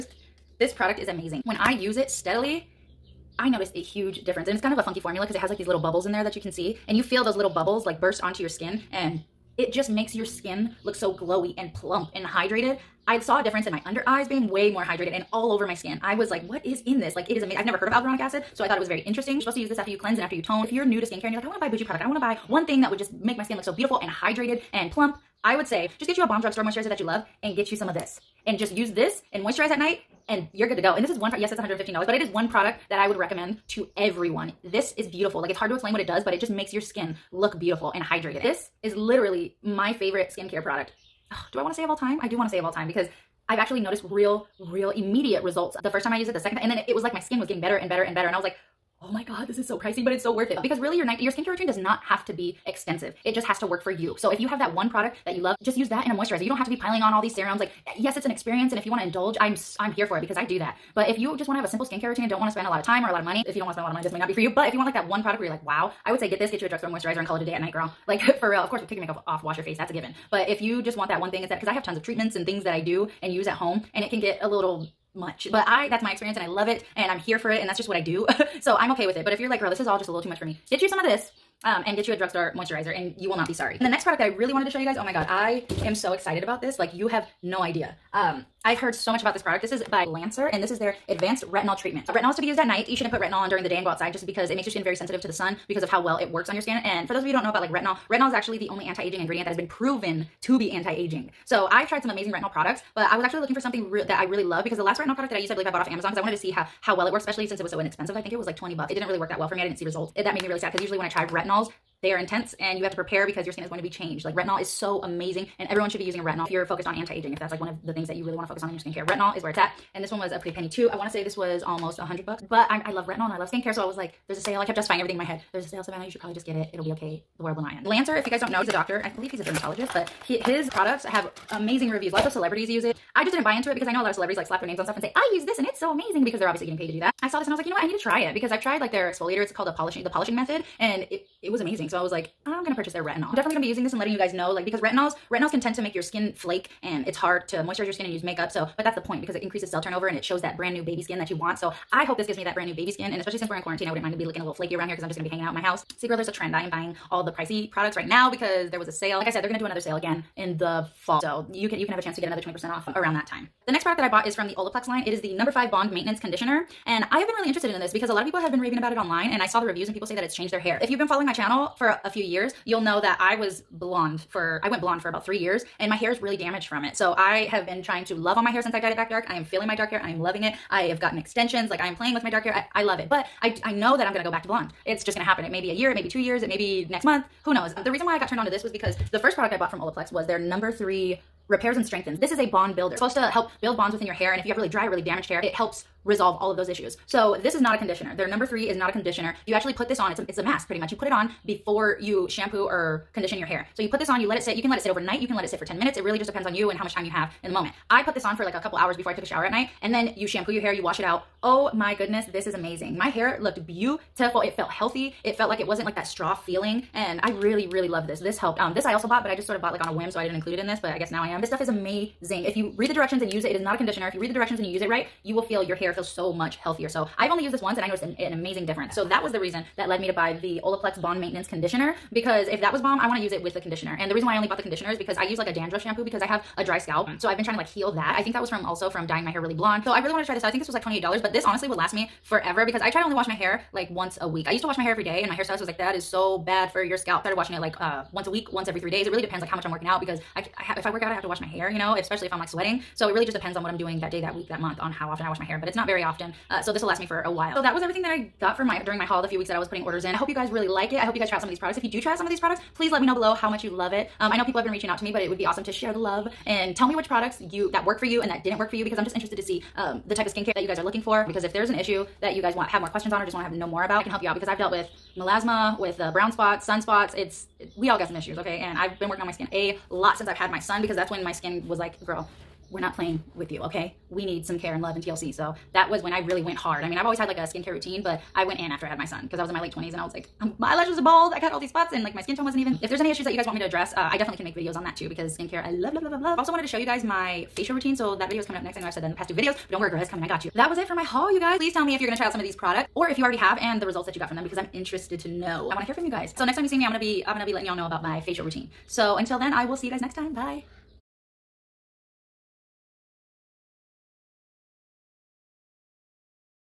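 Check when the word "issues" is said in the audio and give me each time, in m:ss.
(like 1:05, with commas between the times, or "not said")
3:16, 4:31, 4:38, 4:53.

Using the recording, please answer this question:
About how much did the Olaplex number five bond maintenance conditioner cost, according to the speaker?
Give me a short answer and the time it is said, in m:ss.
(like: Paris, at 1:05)
$28, at 4:00.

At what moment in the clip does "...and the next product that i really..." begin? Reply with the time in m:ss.
1:23.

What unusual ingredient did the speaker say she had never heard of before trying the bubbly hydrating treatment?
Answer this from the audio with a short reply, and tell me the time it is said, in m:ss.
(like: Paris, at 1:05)
alguronic acid, at 0:17.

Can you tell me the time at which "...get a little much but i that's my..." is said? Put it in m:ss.
1:14.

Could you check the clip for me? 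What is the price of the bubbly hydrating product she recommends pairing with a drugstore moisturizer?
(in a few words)
$115.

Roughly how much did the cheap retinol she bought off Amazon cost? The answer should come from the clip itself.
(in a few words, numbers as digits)
20 bucks.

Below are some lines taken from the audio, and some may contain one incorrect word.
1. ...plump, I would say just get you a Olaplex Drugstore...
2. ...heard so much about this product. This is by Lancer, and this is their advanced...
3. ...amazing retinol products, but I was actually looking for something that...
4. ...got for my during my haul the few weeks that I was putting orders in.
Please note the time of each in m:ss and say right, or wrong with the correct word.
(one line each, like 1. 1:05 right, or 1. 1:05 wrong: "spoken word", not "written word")
1. 0:24 wrong: "Bomb", not "Olaplex"
2. 1:28 right
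3. 1:42 right
4. 4:18 right.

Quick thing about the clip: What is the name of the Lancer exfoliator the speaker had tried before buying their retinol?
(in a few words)
the polishing method.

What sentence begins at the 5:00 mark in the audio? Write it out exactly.
That was it for my haul, you guys.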